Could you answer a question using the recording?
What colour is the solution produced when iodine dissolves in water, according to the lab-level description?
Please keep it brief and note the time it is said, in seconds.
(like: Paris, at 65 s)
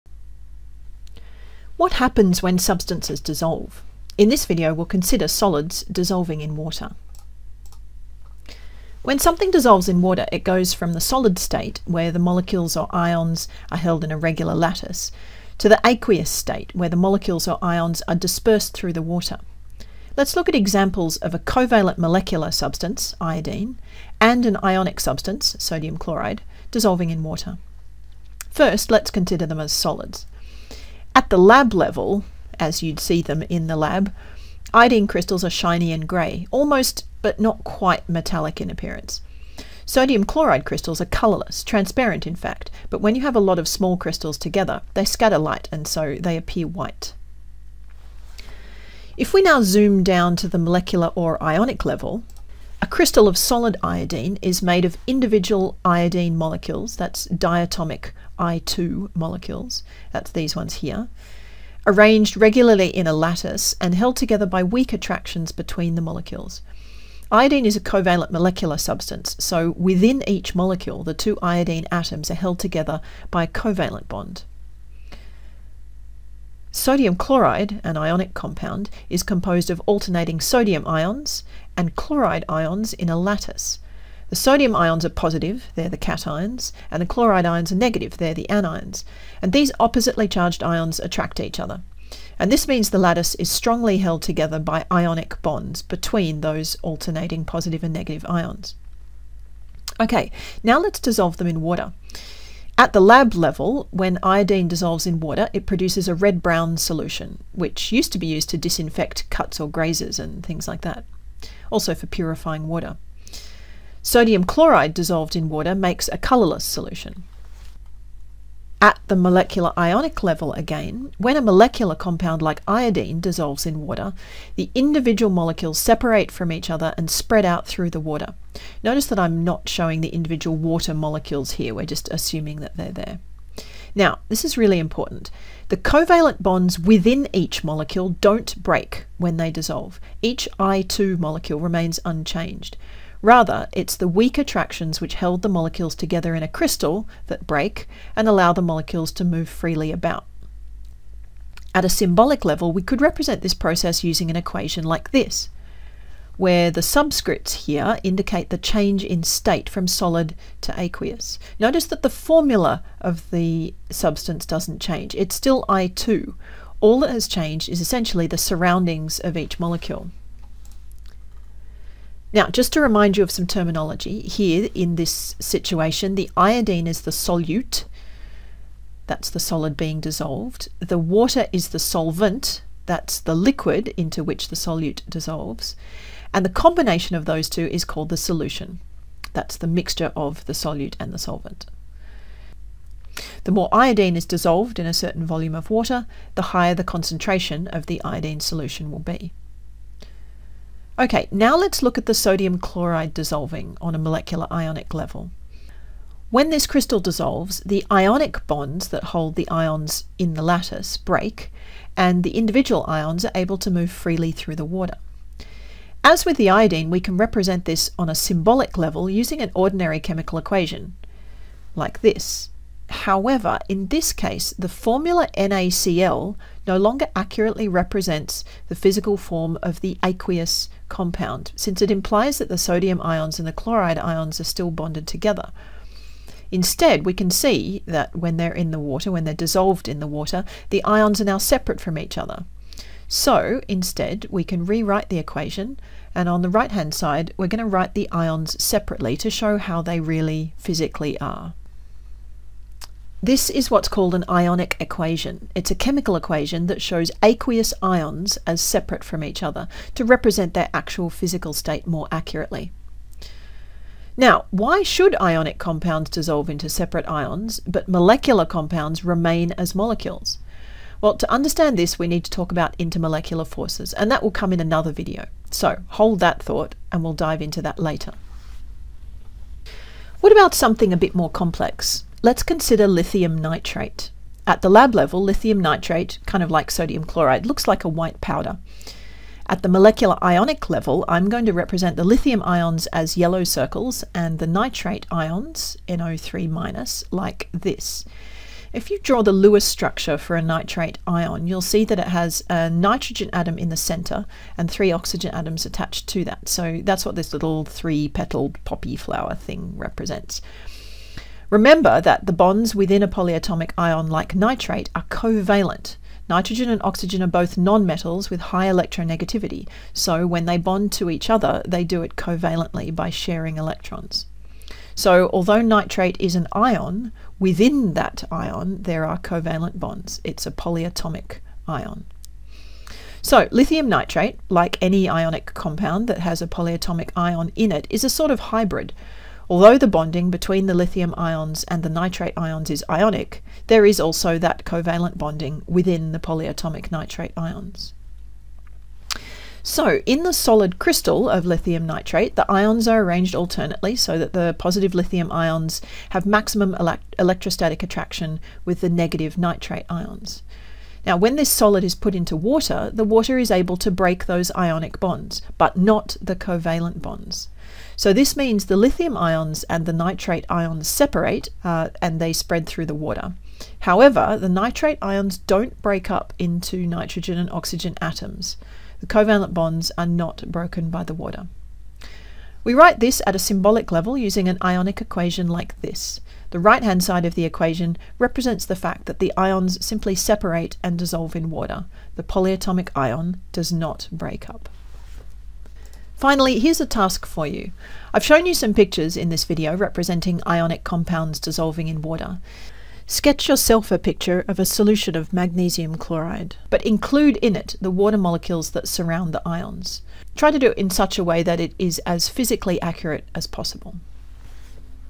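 Red-brown, at 106 s.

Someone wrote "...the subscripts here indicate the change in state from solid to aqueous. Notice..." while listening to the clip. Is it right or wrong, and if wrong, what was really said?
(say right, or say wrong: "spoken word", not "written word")
right.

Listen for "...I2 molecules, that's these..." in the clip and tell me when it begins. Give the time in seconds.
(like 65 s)
58 s.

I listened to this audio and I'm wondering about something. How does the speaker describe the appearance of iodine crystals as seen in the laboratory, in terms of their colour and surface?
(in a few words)
Shiny and grey.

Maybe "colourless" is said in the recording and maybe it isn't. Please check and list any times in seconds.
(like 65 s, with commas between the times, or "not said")
41 s, 116 s.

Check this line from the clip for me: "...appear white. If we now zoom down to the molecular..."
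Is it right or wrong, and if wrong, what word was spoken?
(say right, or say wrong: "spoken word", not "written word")
right.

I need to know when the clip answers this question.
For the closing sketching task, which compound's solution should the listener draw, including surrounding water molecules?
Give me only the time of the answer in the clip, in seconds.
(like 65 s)
405 s.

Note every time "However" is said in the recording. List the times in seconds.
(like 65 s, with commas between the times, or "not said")
223 s, 373 s.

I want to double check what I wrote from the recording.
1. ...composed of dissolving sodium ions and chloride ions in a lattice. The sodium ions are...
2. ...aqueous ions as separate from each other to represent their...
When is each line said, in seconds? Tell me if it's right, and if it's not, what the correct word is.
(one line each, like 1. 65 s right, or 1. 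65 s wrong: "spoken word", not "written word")
1. 79 s wrong: "alternating", not "dissolving"
2. 257 s right.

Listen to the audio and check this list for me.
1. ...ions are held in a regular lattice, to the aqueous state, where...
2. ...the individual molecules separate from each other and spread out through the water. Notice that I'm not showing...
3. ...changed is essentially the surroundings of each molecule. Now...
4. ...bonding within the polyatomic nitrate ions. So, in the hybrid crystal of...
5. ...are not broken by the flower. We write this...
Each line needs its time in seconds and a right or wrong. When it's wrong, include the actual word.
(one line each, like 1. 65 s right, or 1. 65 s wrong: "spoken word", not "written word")
1. 12 s right
2. 124 s right
3. 167 s right
4. 345 s wrong: "solid", not "hybrid"
5. 379 s wrong: "water", not "flower".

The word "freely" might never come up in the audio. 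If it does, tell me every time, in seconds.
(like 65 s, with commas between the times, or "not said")
149 s, 213 s.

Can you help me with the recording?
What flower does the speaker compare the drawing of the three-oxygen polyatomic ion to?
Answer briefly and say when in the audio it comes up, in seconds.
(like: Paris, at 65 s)
Poppy, at 308 s.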